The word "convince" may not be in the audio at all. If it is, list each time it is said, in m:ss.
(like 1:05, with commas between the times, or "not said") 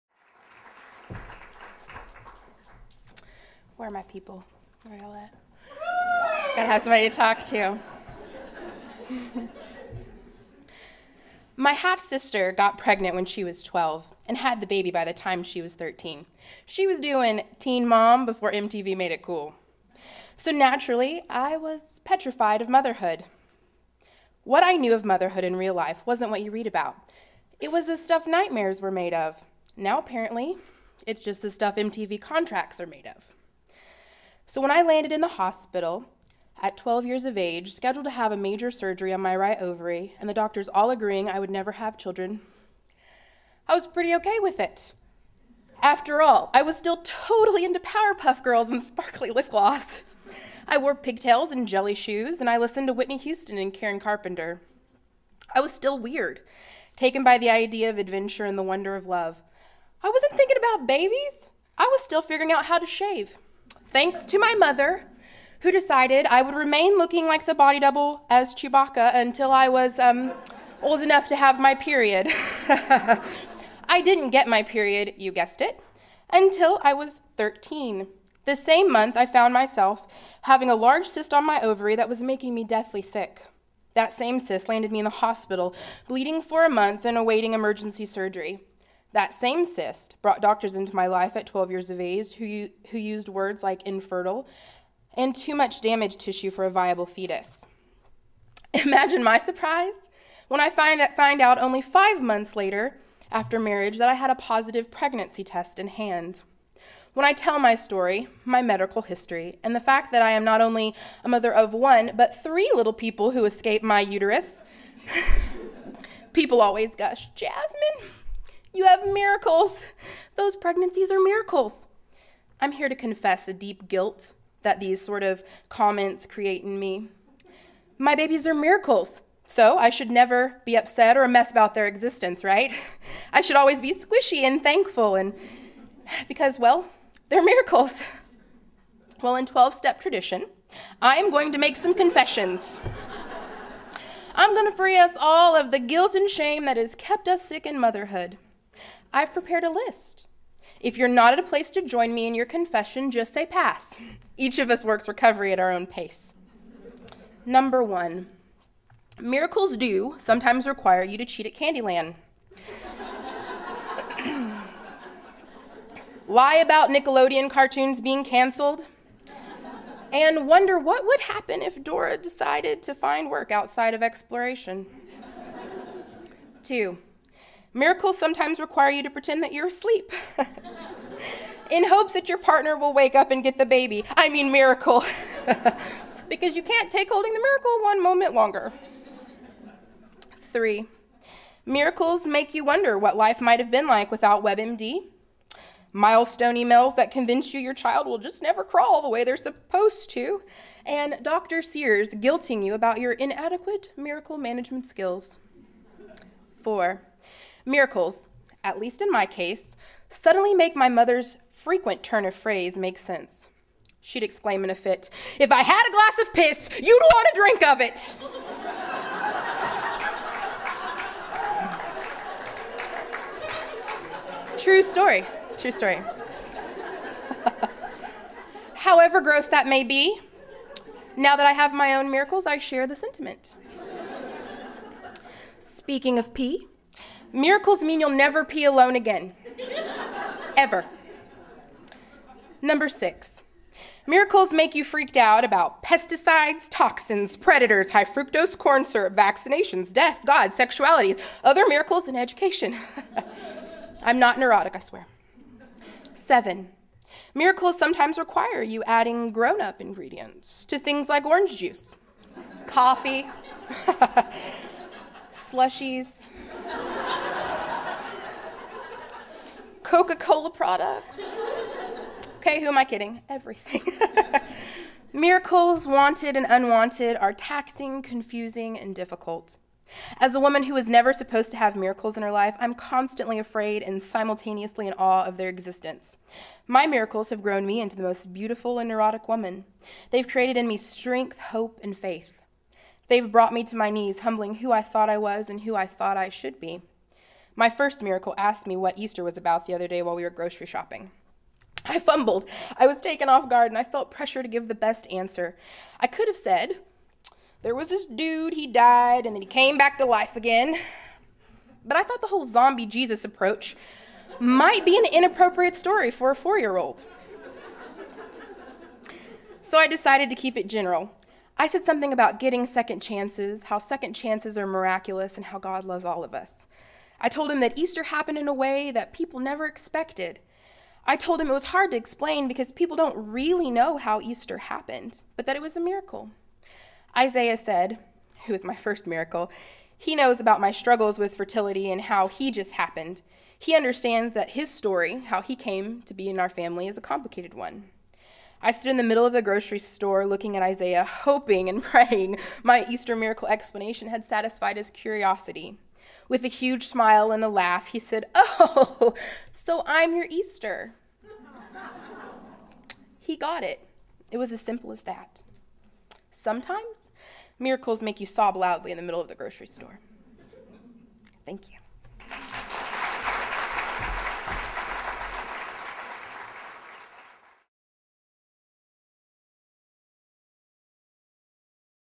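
3:17.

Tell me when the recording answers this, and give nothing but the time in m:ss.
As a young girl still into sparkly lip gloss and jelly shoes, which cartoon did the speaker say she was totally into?
0:47.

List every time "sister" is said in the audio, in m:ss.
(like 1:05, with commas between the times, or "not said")
0:11.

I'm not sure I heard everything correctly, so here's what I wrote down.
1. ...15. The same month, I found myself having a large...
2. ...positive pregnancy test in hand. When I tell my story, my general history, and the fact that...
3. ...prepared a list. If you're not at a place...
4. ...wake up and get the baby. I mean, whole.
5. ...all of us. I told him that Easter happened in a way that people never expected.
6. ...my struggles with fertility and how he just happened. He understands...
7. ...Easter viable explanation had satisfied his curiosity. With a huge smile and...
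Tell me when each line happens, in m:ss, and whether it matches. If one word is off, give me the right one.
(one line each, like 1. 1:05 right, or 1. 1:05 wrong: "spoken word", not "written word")
1. 1:17 wrong: "13", not "15"
2. 1:44 wrong: "medical", not "general"
3. 2:29 right
4. 3:02 wrong: "miracle", not "whole"
5. 5:26 right
6. 5:40 right
7. 5:52 wrong: "miracle", not "viable".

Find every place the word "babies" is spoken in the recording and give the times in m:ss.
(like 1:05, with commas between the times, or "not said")
1:00, 2:08.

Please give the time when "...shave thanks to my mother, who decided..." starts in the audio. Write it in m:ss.
1:02.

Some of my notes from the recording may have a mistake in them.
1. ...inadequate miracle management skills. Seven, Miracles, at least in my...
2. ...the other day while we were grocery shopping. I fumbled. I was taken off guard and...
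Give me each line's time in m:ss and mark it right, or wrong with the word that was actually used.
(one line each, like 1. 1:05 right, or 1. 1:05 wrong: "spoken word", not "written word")
1. 3:23 wrong: "Four", not "Seven"
2. 4:59 right.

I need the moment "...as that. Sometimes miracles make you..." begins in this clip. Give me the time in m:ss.
6:04.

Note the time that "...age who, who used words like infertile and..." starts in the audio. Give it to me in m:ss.
1:31.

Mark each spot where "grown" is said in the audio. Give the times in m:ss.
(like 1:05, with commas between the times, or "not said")
4:19, 4:47.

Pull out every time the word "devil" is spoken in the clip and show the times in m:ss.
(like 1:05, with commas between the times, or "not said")
not said.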